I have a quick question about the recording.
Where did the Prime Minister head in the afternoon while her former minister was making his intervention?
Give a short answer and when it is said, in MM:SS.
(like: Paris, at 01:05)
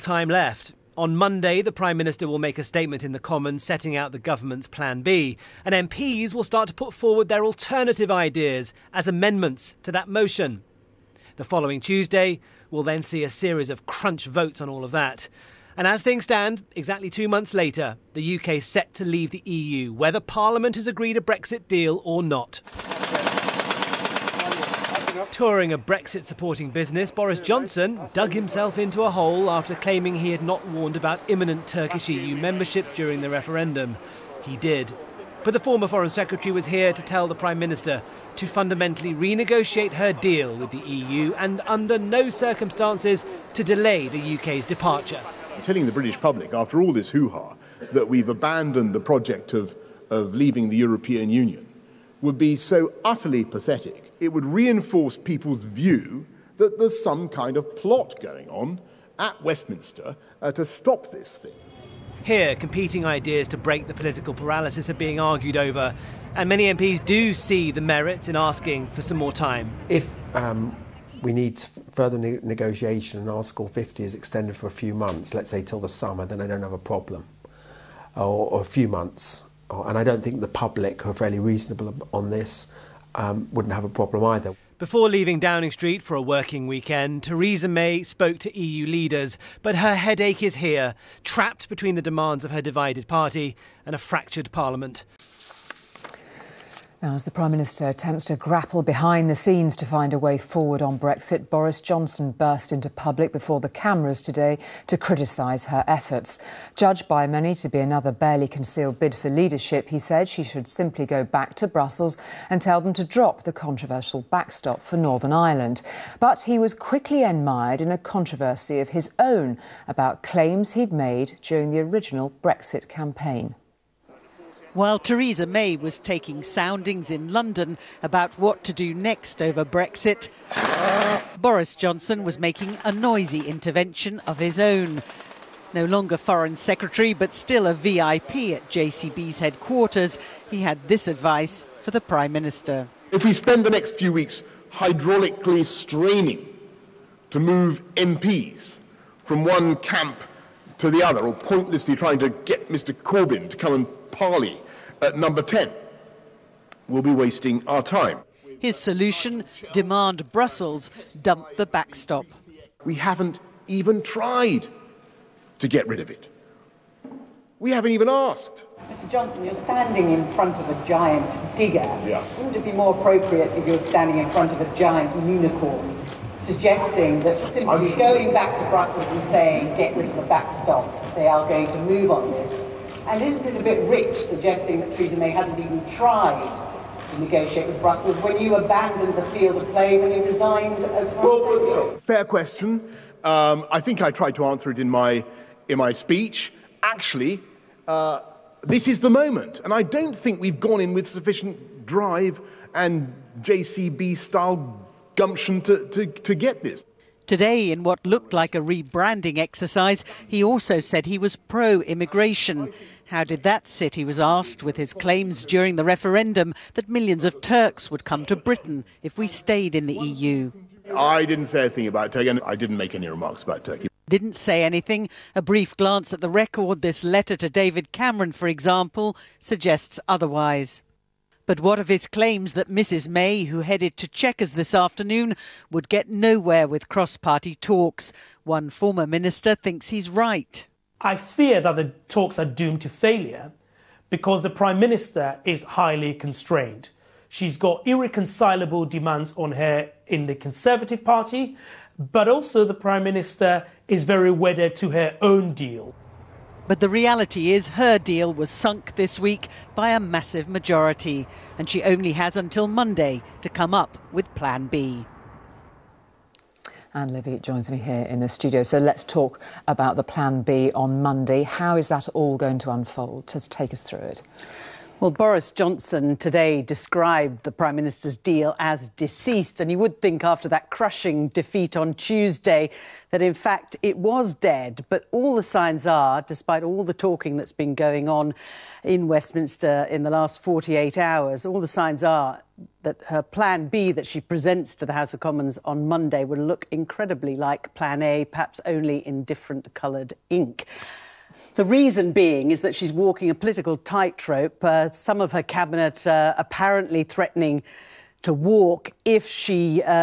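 Chequers, at 03:54.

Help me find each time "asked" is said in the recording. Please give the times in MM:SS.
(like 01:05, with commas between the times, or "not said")
02:48, 03:34.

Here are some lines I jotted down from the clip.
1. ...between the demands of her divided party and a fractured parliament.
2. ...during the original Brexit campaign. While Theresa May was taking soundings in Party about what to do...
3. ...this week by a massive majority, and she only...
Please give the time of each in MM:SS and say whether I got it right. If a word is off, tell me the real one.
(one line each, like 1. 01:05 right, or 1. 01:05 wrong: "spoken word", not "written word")
1. 01:31 right
2. 02:01 wrong: "London", not "Party"
3. 04:18 right.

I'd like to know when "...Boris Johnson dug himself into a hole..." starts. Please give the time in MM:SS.
00:27.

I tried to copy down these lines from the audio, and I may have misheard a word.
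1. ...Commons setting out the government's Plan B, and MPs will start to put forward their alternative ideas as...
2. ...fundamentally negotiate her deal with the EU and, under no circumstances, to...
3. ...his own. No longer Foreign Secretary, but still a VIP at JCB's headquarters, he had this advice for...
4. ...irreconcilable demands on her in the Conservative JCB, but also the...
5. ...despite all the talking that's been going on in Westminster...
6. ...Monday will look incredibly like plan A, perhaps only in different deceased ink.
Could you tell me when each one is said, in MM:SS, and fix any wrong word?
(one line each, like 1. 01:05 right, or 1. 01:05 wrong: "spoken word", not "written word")
1. 00:03 right
2. 00:38 wrong: "renegotiate", not "negotiate"
3. 02:14 right
4. 04:07 wrong: "Party", not "JCB"
5. 04:46 right
6. 04:55 wrong: "coloured", not "deceased".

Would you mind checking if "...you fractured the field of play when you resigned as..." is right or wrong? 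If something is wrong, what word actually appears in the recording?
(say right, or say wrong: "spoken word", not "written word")
wrong: "abandoned", not "fractured".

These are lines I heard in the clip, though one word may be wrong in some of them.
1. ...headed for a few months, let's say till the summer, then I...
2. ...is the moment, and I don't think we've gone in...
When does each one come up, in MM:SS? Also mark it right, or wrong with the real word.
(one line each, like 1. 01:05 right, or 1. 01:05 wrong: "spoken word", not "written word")
1. 01:14 wrong: "extended", not "headed"
2. 03:18 right.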